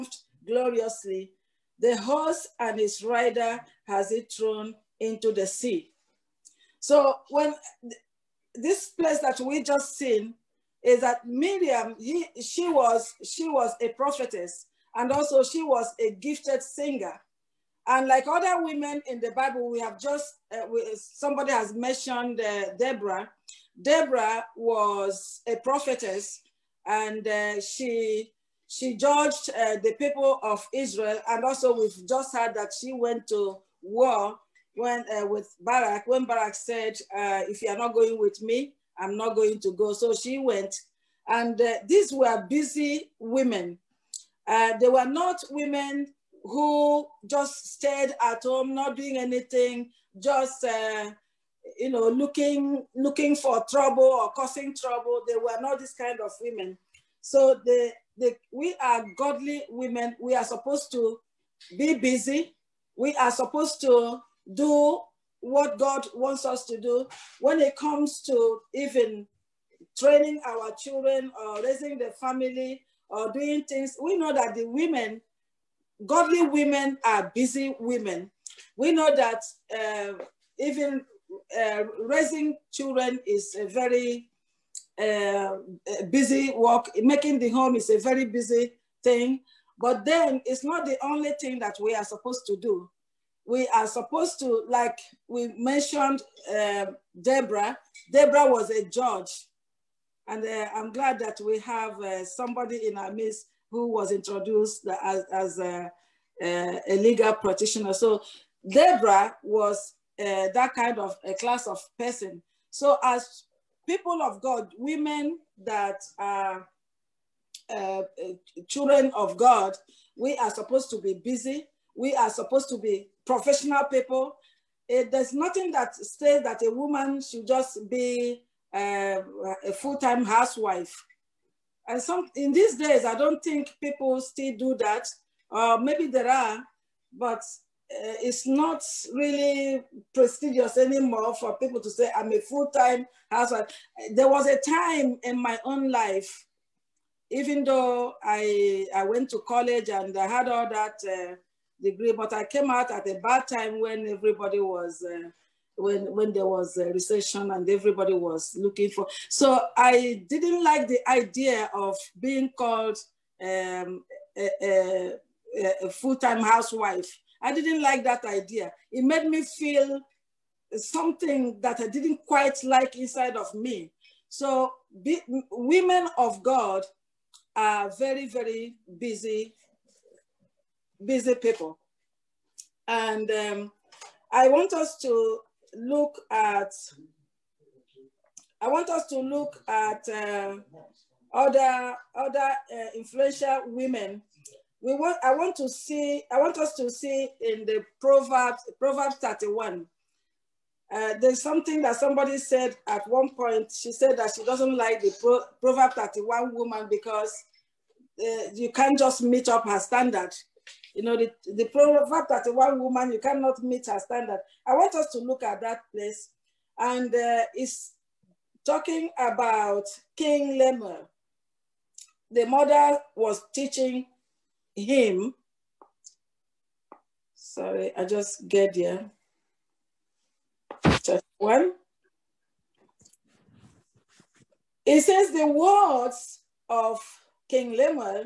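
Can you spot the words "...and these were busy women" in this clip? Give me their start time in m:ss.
0:41.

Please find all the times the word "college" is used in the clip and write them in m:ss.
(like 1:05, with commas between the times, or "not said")
2:29.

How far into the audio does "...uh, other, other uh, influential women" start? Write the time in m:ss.
3:10.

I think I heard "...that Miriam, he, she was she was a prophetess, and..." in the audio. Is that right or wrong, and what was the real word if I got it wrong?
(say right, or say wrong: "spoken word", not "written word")
right.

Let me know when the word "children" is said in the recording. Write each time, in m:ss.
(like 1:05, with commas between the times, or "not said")
1:10, 1:22, 1:58.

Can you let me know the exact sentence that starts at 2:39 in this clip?
So I didn't like the idea of being called um, a, a, a full-time housewife.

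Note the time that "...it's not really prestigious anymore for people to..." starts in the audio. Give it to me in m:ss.
2:18.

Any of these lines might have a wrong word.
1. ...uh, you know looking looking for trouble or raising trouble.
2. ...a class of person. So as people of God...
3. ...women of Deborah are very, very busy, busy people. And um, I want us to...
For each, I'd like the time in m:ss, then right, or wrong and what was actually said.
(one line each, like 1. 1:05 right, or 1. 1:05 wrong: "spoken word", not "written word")
1. 0:50 wrong: "causing", not "raising"
2. 1:51 right
3. 2:55 wrong: "God", not "Deborah".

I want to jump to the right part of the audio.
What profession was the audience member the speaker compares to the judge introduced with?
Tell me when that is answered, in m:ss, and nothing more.
1:46.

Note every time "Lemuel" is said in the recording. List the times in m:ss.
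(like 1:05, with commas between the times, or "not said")
3:40, 3:57.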